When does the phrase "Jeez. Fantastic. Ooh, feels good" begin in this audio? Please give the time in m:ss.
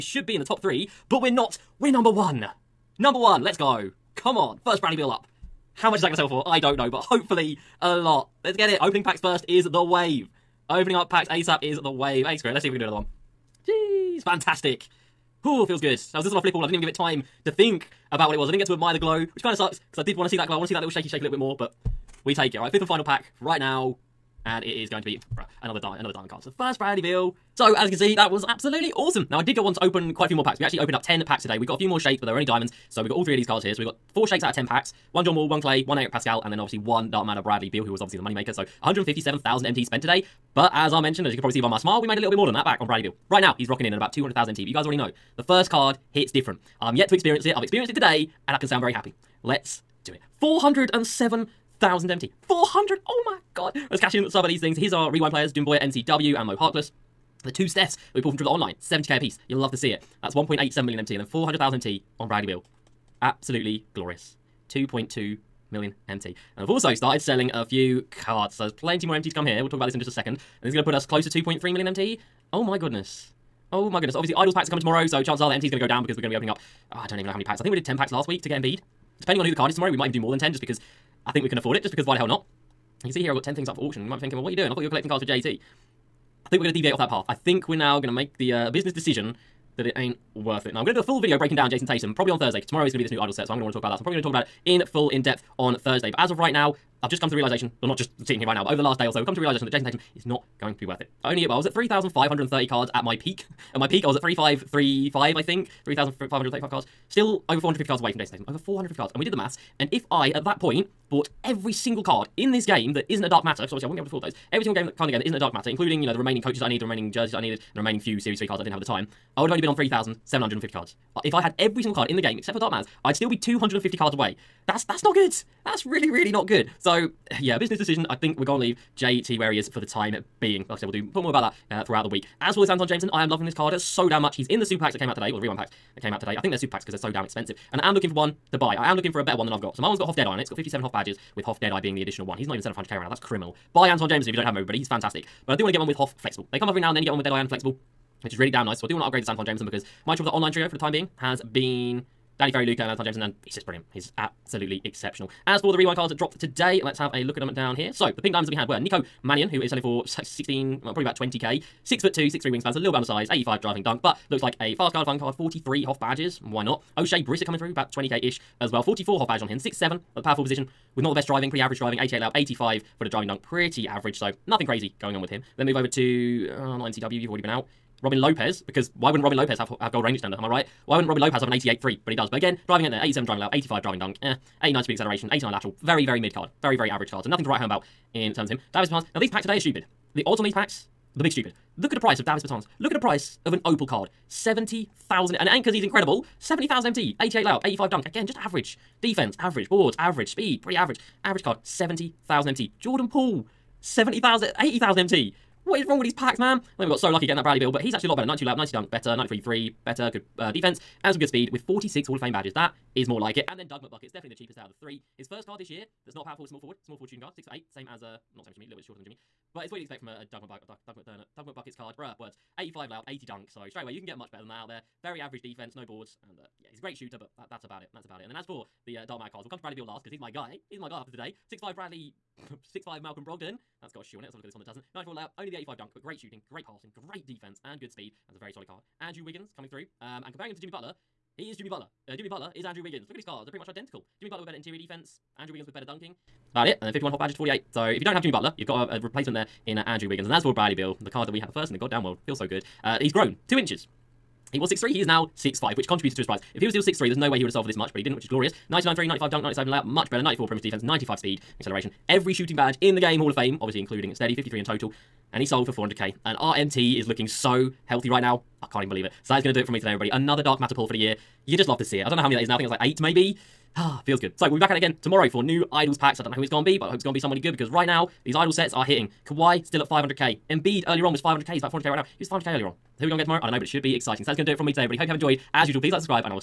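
0:13.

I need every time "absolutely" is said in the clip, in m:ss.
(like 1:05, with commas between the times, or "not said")
0:28, 1:03, 2:34.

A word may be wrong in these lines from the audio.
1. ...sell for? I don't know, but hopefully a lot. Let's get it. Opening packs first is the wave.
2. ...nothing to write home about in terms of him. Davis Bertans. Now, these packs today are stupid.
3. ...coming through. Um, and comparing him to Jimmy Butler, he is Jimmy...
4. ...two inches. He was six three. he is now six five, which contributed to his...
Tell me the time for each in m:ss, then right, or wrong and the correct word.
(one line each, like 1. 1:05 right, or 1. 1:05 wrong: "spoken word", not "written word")
1. 0:06 right
2. 3:07 right
3. 3:59 right
4. 4:13 right.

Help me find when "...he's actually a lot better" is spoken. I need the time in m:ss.
3:27.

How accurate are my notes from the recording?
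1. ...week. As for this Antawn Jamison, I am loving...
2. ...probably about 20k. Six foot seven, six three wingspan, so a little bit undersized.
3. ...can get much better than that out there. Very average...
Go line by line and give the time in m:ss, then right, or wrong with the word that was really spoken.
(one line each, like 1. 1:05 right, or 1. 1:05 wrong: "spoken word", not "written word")
1. 2:12 right
2. 2:40 wrong: "two", not "seven"
3. 3:43 right.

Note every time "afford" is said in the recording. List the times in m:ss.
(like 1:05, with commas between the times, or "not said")
1:21, 1:54.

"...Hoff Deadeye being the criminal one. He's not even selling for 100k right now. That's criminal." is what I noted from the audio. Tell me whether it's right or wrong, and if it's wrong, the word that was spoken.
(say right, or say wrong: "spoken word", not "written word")
wrong: "additional", not "criminal".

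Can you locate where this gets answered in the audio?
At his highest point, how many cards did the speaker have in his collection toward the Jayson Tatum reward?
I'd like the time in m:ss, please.
1:45.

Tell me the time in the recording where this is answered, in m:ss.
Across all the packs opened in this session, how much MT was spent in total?
0:38.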